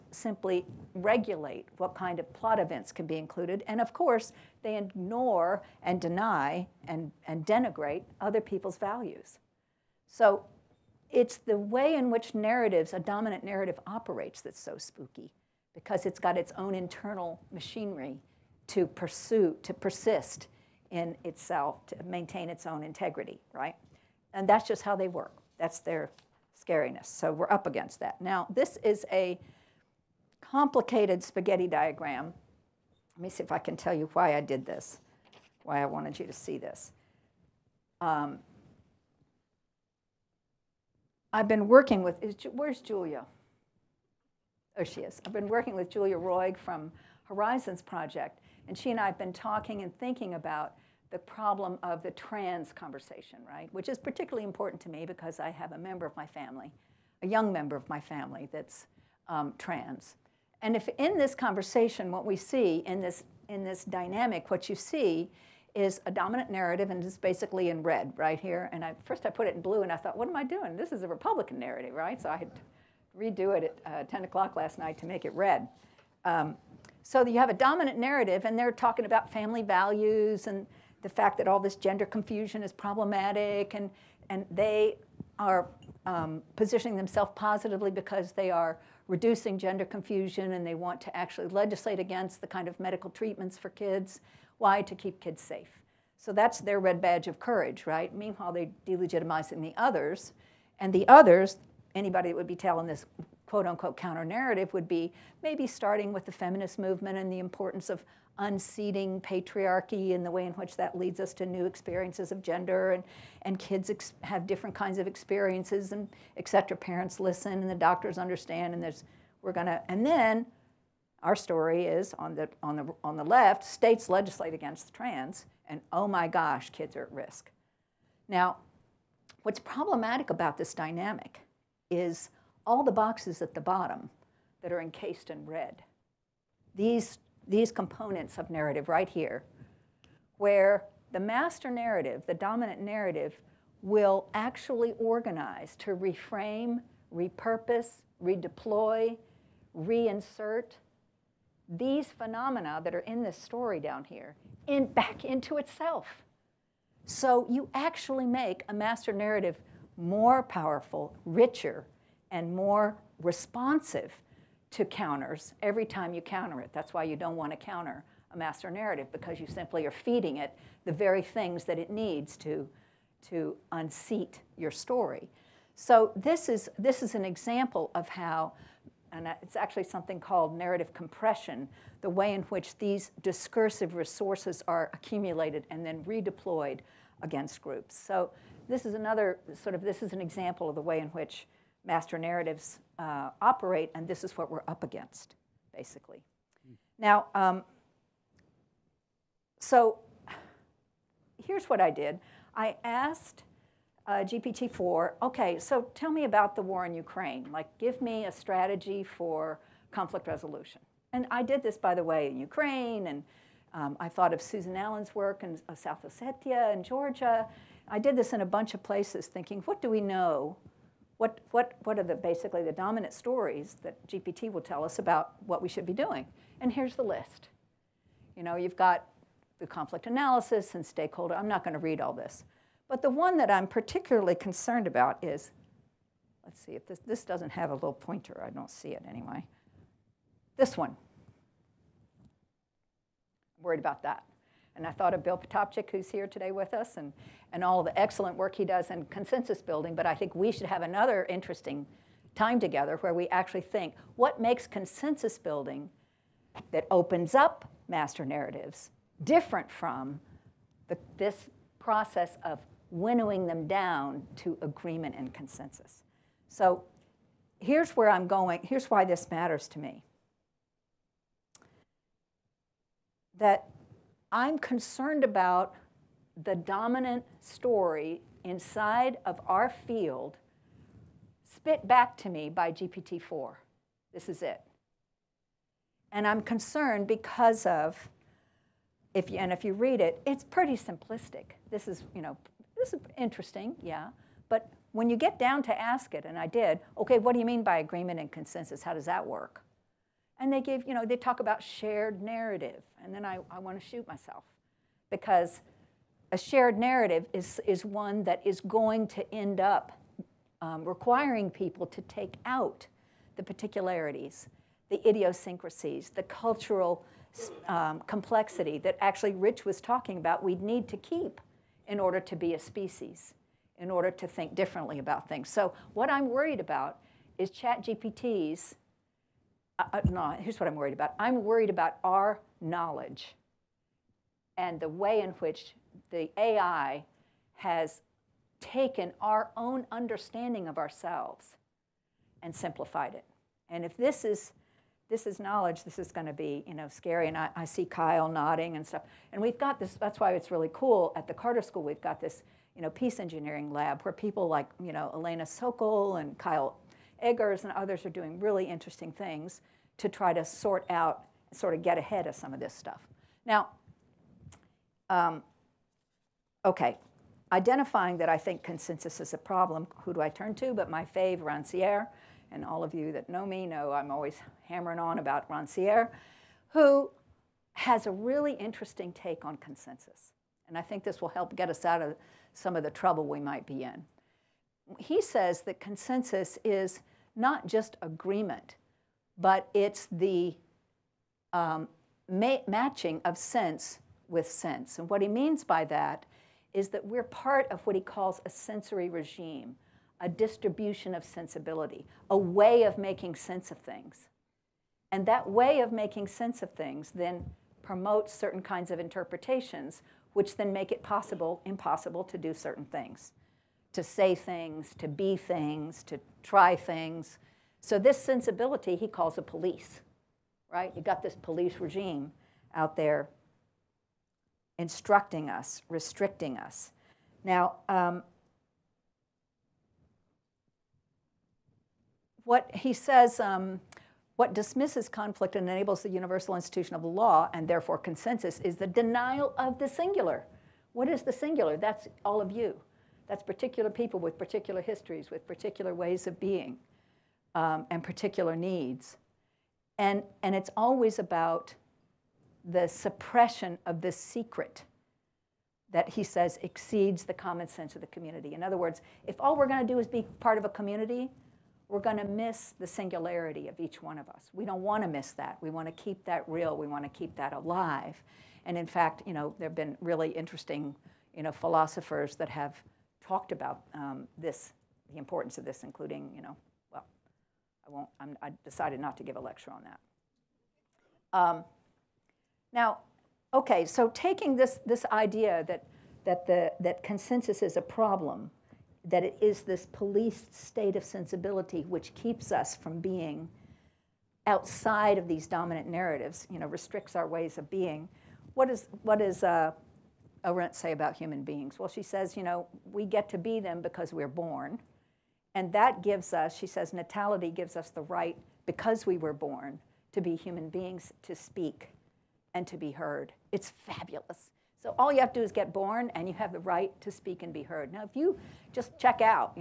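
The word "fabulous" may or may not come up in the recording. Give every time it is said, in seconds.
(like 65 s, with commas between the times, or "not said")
513 s.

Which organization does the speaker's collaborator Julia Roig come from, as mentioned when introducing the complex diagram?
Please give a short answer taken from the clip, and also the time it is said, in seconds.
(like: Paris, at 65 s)
Horizons Project, at 47 s.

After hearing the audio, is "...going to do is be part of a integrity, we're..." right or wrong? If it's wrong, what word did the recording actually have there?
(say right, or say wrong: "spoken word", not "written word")
wrong: "community", not "integrity".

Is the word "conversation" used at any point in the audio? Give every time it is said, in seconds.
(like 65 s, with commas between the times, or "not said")
52 s, 61 s.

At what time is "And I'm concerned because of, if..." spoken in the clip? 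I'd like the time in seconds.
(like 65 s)
286 s.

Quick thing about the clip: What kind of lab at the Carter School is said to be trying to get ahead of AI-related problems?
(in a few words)
peace engineering lab.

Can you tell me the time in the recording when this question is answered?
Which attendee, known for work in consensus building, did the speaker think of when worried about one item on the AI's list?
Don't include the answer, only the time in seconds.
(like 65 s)
245 s.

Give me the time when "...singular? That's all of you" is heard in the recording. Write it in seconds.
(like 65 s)
441 s.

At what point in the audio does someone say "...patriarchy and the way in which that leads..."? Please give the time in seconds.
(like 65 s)
109 s.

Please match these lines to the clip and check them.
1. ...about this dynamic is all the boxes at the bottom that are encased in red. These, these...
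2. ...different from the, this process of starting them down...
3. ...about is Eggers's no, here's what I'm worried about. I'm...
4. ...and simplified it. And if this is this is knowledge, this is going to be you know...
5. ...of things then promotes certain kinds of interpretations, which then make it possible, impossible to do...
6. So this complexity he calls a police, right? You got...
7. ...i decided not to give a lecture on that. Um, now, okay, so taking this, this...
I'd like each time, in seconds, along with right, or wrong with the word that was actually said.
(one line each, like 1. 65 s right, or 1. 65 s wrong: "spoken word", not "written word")
1. 130 s right
2. 259 s wrong: "winnowing", not "starting"
3. 326 s wrong: "ChatGPT", not "Eggers"
4. 342 s right
5. 406 s right
6. 417 s wrong: "sensibility", not "complexity"
7. 478 s right.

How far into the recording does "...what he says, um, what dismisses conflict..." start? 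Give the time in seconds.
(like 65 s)
432 s.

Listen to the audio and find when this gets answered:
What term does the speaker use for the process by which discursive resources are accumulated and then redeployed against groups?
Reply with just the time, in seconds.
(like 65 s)
180 s.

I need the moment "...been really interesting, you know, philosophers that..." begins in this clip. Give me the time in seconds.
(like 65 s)
469 s.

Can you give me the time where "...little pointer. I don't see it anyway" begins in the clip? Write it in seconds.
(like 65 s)
237 s.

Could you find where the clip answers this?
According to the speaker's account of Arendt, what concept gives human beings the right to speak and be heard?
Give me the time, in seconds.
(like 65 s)
506 s.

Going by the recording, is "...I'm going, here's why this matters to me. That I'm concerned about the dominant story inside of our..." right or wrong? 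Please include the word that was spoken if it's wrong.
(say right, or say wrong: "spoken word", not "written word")
right.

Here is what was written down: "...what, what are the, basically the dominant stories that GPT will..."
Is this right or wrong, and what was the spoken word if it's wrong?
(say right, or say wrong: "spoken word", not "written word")
right.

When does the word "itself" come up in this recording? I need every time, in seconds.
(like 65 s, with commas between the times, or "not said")
21 s, 155 s.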